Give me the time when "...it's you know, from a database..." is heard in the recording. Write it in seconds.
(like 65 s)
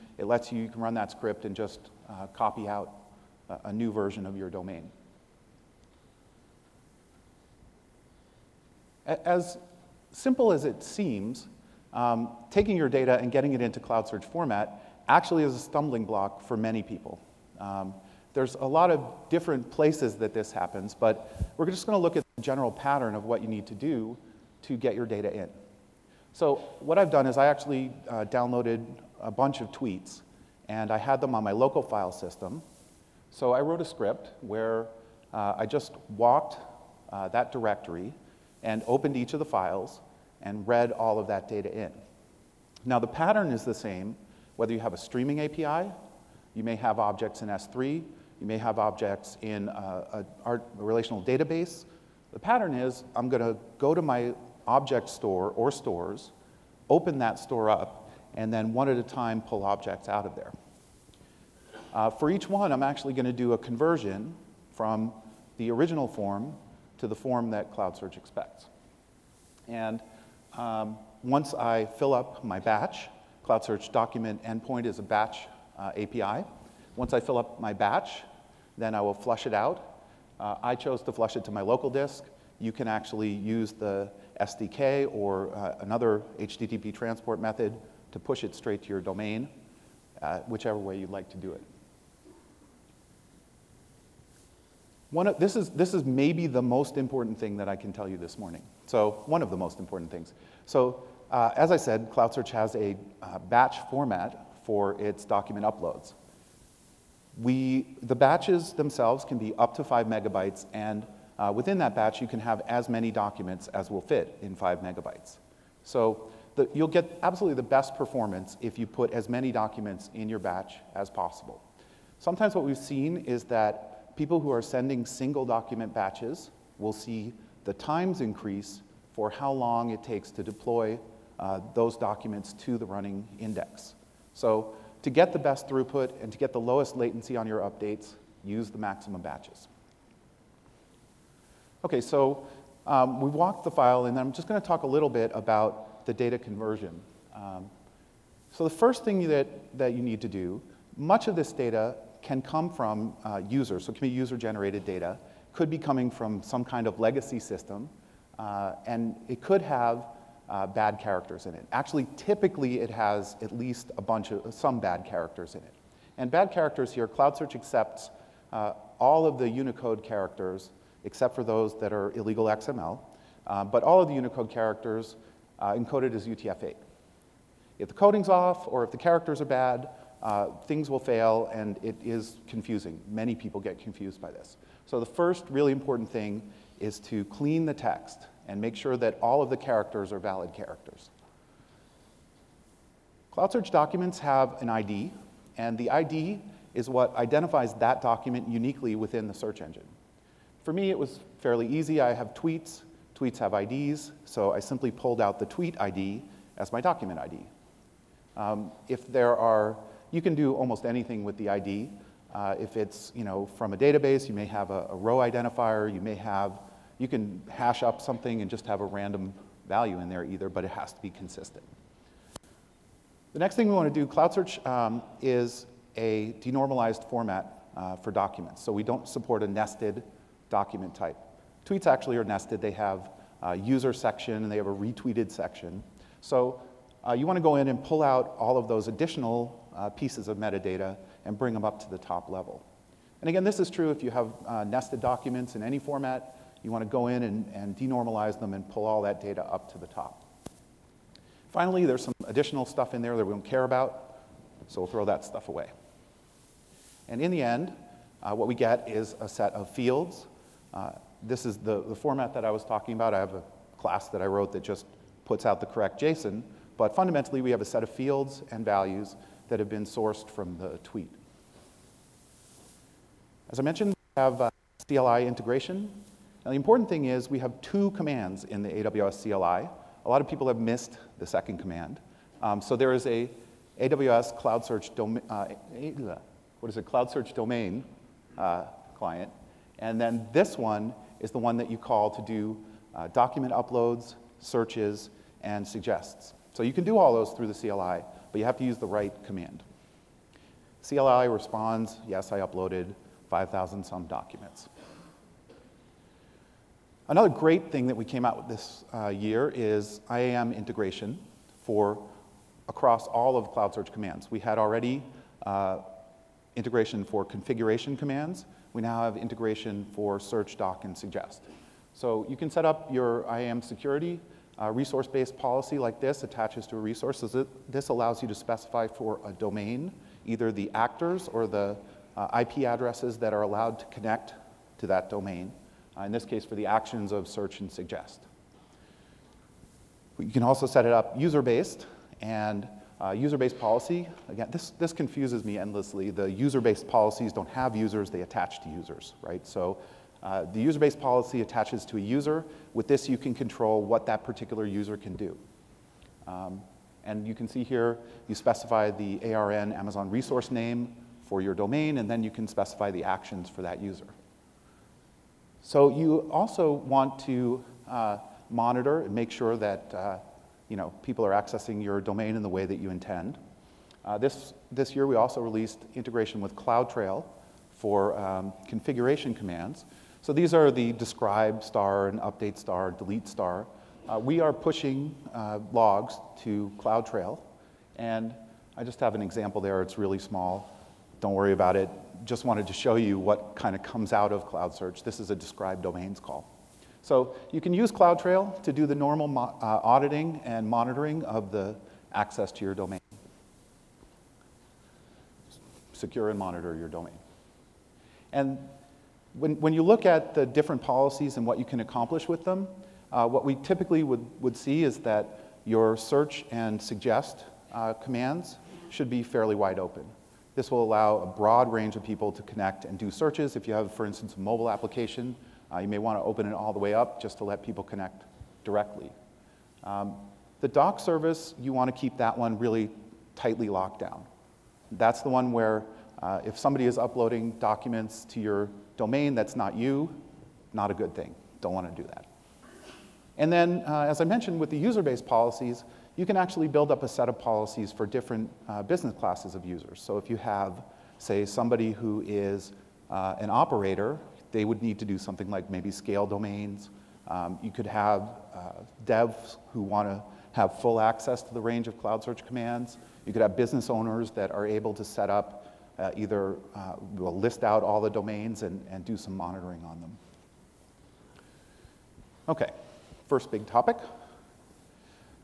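212 s.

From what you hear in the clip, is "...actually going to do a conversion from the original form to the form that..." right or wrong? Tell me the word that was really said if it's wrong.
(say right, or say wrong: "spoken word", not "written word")
right.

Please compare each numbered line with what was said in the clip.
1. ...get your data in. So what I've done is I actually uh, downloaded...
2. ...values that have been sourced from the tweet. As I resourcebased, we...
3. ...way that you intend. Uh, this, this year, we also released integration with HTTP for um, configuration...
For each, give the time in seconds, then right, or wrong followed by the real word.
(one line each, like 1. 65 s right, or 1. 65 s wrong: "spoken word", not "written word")
1. 24 s right
2. 268 s wrong: "mentioned", not "resourcebased"
3. 372 s wrong: "CloudTrail", not "HTTP".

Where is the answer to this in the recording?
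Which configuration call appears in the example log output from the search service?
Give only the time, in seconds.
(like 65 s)
395 s.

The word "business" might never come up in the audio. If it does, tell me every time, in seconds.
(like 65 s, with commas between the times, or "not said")
448 s, 463 s.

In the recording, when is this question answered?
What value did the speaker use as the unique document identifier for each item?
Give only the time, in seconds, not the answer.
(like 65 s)
205 s.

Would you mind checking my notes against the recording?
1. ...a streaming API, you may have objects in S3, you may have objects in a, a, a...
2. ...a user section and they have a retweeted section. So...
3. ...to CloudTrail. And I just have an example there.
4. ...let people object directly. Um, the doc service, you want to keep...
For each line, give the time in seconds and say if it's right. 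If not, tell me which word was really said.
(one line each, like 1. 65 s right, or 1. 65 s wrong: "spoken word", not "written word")
1. 44 s right
2. 233 s right
3. 386 s right
4. 427 s wrong: "connect", not "object".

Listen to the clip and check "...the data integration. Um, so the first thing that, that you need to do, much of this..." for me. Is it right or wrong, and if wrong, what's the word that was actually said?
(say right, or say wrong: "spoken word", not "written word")
wrong: "conversion", not "integration".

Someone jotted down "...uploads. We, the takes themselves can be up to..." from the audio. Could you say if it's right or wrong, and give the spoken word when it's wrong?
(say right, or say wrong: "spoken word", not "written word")
wrong: "batches", not "takes".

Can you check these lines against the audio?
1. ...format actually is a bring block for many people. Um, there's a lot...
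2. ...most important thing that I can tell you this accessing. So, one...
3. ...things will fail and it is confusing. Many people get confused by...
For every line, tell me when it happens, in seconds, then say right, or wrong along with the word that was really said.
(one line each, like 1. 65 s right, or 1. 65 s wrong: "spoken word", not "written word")
1. 14 s wrong: "stumbling", not "bring"
2. 96 s wrong: "morning", not "accessing"
3. 180 s right.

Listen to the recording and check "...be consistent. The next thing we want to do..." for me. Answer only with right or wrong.
right.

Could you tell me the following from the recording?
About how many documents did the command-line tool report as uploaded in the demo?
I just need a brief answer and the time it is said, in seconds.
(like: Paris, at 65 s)
5,000, at 303 s.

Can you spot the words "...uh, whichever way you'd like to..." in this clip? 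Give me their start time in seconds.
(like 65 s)
90 s.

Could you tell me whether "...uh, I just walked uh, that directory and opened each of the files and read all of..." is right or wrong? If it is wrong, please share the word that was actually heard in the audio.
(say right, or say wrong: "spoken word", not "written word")
right.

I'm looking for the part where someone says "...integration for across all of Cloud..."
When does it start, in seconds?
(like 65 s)
310 s.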